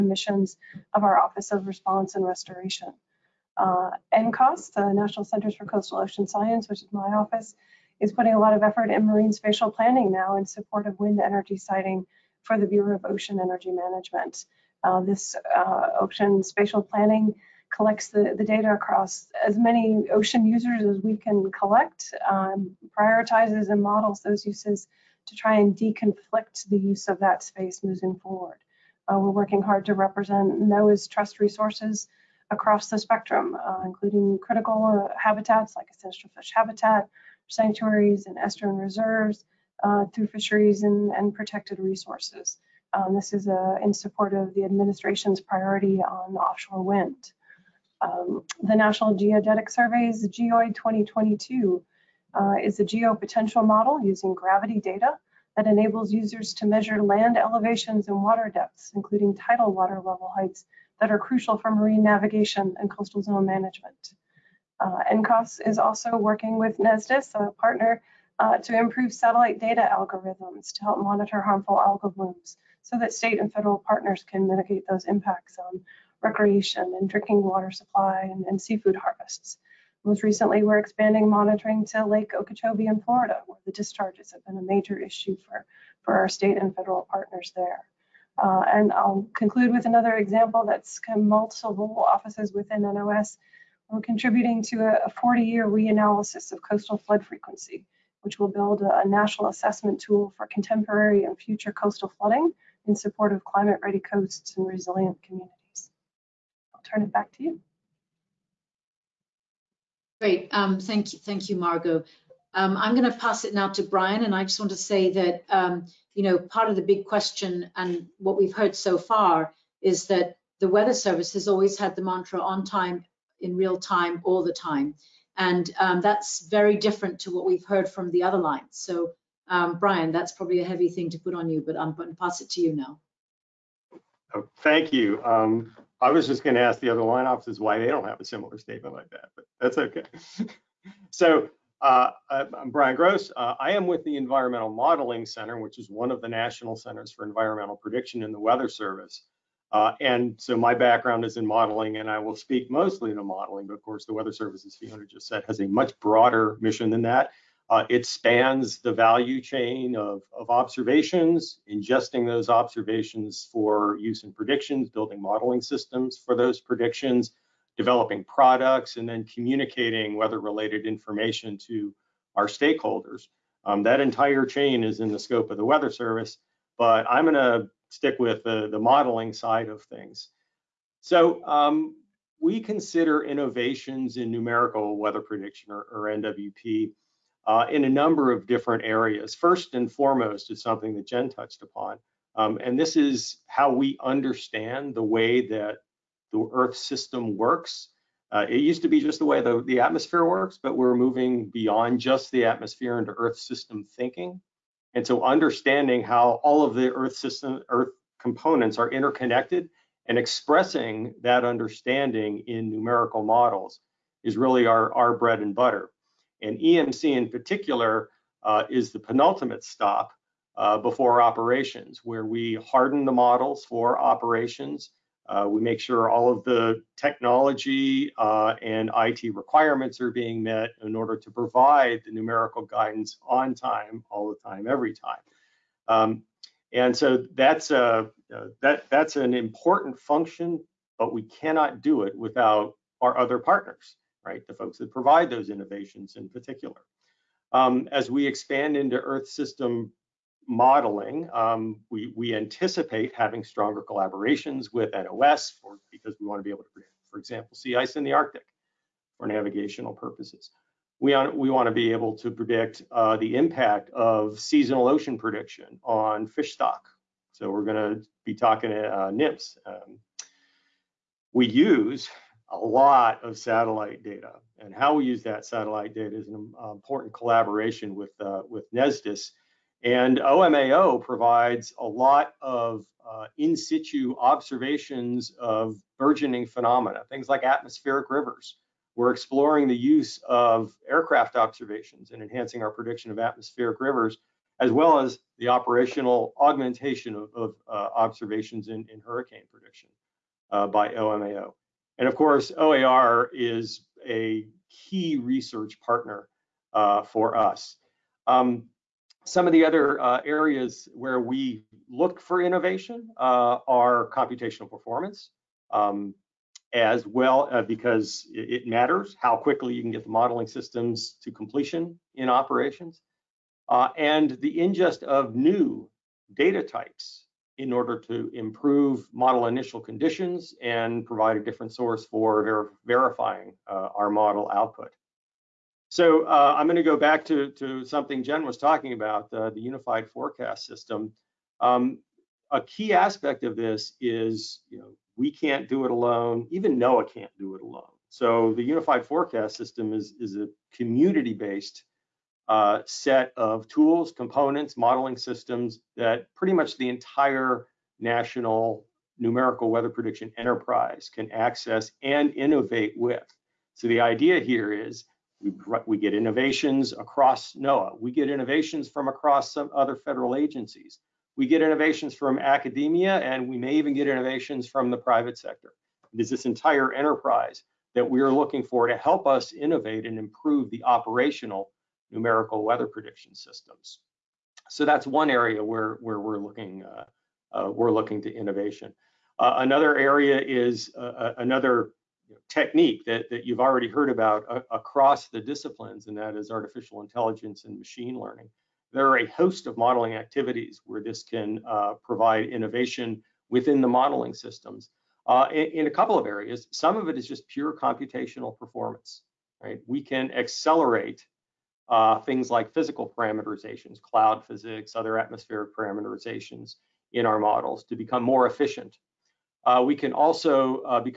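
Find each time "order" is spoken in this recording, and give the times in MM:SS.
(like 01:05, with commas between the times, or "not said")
03:50, 05:27.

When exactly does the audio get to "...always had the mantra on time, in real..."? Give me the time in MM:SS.
02:01.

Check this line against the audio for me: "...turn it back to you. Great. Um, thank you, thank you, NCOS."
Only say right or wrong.
wrong.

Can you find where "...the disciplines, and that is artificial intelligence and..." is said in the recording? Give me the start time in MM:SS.
06:35.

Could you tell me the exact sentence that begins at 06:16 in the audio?
It is this entire enterprise that we are looking for to help us innovate and improve the operational numerical weather prediction systems.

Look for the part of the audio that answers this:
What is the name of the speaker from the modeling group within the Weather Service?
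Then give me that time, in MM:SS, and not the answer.
02:22.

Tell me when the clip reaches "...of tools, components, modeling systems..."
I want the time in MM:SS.
05:53.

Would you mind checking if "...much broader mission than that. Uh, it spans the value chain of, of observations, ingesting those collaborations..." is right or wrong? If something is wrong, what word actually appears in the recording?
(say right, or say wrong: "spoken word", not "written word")
wrong: "observations", not "collaborations".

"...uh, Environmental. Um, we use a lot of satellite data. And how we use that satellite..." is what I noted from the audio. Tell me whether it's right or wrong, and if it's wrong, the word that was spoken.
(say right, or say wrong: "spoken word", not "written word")
wrong: "NMFS", not "Environmental".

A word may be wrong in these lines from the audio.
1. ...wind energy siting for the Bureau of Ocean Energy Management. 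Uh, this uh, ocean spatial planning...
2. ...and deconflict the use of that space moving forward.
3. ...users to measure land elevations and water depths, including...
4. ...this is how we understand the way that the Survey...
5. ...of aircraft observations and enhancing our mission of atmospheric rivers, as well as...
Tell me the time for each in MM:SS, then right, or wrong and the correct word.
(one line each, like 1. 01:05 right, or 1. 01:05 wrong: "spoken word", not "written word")
1. 00:10 right
2. 00:25 right
3. 00:56 right
4. 03:12 wrong: "Earth", not "Survey"
5. 04:50 wrong: "prediction", not "mission".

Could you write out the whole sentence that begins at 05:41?
Um, a key aspect of this is, you know, we can't do it alone.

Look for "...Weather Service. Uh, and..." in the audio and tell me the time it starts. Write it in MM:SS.
02:28.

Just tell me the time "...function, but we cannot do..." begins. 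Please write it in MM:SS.
03:59.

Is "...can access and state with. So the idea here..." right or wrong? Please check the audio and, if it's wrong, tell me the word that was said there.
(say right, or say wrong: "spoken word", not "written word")
wrong: "innovate", not "state".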